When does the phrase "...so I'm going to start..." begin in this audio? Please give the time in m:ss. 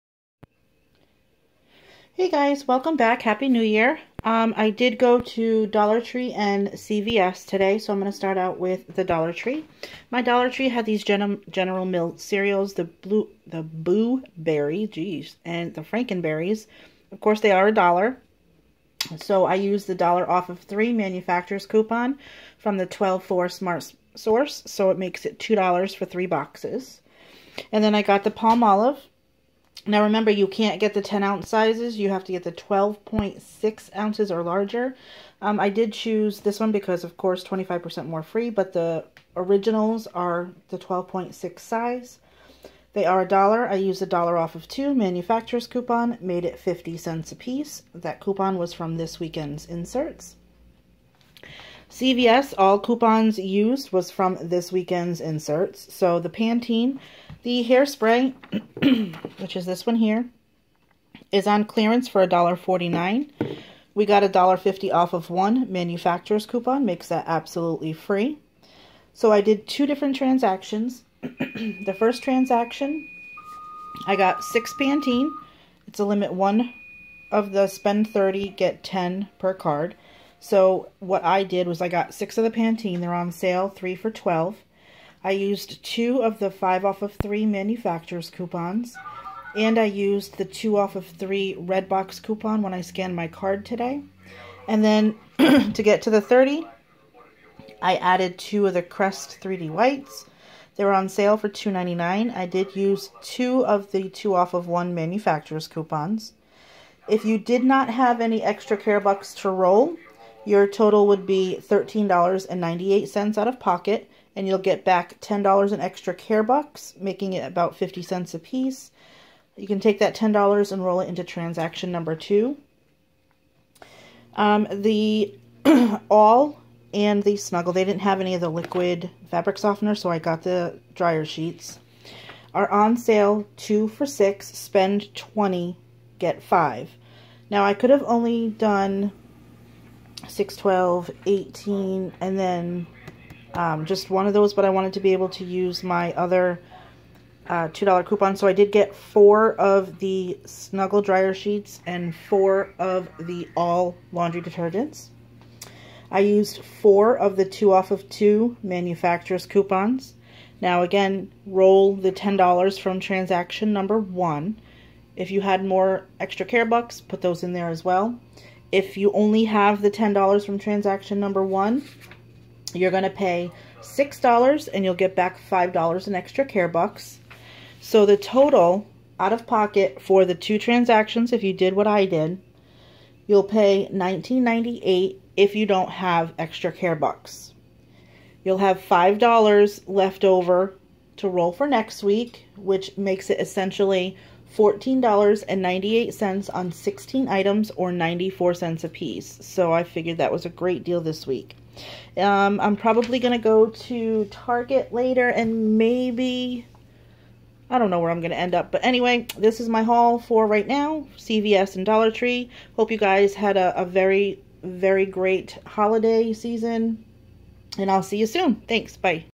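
0:07.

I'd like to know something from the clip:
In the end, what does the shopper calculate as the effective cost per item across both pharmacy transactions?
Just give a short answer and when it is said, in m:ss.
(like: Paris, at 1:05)
94 cents, at 3:17.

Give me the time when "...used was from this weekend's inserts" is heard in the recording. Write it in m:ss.
0:53.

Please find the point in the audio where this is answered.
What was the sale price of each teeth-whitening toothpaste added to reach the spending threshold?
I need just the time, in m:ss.
1:41.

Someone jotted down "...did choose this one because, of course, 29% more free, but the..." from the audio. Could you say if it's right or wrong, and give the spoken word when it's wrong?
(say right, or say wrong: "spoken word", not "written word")
wrong: "25", not "29".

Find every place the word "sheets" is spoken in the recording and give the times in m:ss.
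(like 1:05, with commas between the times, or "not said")
2:11, 2:31.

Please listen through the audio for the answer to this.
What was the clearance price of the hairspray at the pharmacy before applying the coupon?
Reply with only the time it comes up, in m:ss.
1:02.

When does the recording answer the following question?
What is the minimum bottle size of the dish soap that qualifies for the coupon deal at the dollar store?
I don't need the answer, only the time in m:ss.
0:32.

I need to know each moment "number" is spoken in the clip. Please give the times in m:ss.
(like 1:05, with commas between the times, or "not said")
2:01, 2:43, 2:51.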